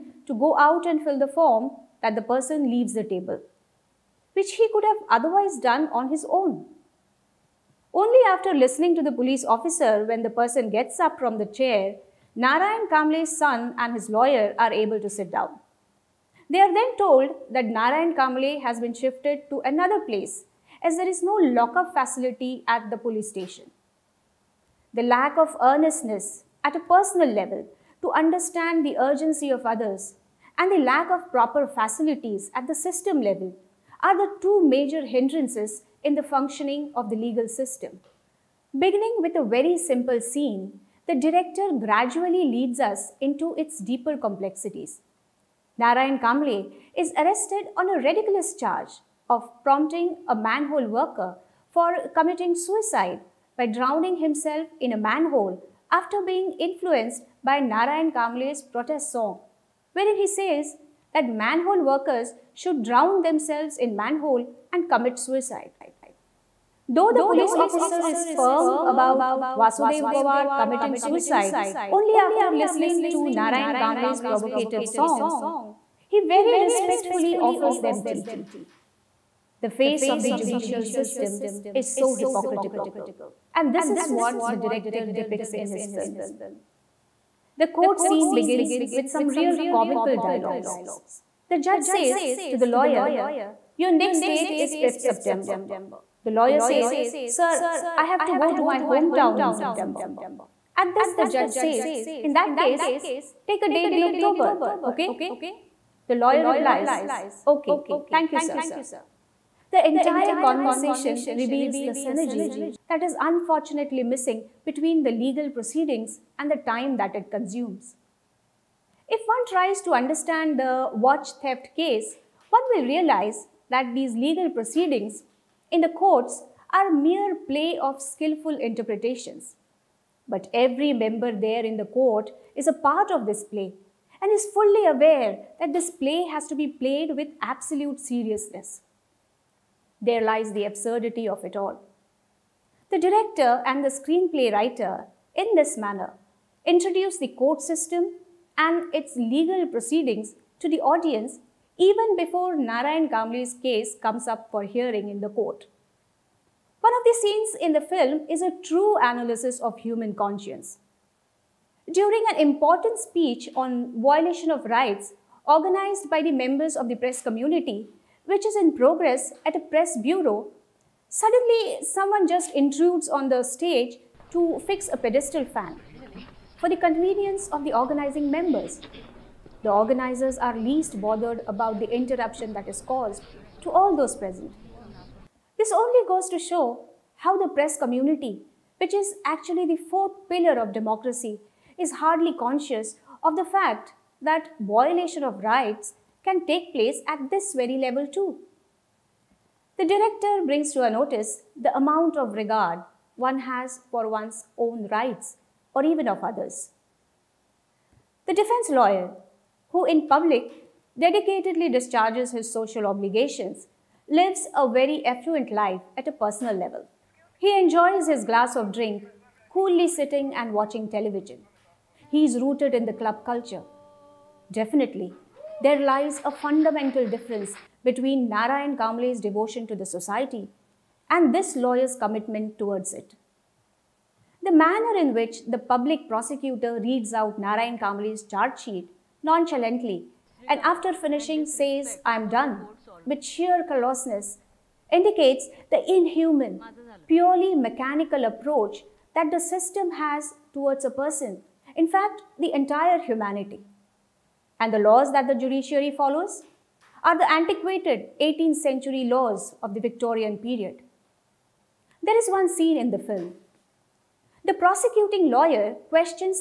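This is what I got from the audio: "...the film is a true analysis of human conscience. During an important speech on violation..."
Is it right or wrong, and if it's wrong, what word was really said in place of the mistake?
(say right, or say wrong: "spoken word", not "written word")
right.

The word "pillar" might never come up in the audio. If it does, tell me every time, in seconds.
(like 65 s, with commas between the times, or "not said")
190 s.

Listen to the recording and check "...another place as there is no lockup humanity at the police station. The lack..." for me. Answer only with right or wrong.
wrong.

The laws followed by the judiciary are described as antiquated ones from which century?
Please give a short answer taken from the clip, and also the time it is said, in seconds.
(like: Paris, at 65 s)
18th century, at 258 s.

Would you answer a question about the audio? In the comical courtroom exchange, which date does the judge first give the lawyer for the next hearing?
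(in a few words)
5th September.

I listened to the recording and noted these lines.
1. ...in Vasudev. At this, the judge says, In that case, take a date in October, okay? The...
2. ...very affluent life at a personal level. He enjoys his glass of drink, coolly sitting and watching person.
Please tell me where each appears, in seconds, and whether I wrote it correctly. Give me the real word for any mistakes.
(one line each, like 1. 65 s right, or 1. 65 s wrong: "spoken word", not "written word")
1. 99 s wrong: "September", not "Vasudev"
2. 214 s wrong: "television", not "person".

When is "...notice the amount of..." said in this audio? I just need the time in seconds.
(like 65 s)
200 s.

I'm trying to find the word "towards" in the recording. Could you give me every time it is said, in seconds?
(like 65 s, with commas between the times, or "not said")
232 s, 250 s.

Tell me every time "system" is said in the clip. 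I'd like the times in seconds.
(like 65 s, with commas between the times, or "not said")
32 s, 37 s, 80 s, 147 s, 249 s.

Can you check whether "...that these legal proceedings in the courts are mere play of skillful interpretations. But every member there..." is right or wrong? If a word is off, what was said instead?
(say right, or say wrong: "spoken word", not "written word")
right.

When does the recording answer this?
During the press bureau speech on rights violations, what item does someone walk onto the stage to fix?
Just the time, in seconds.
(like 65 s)
174 s.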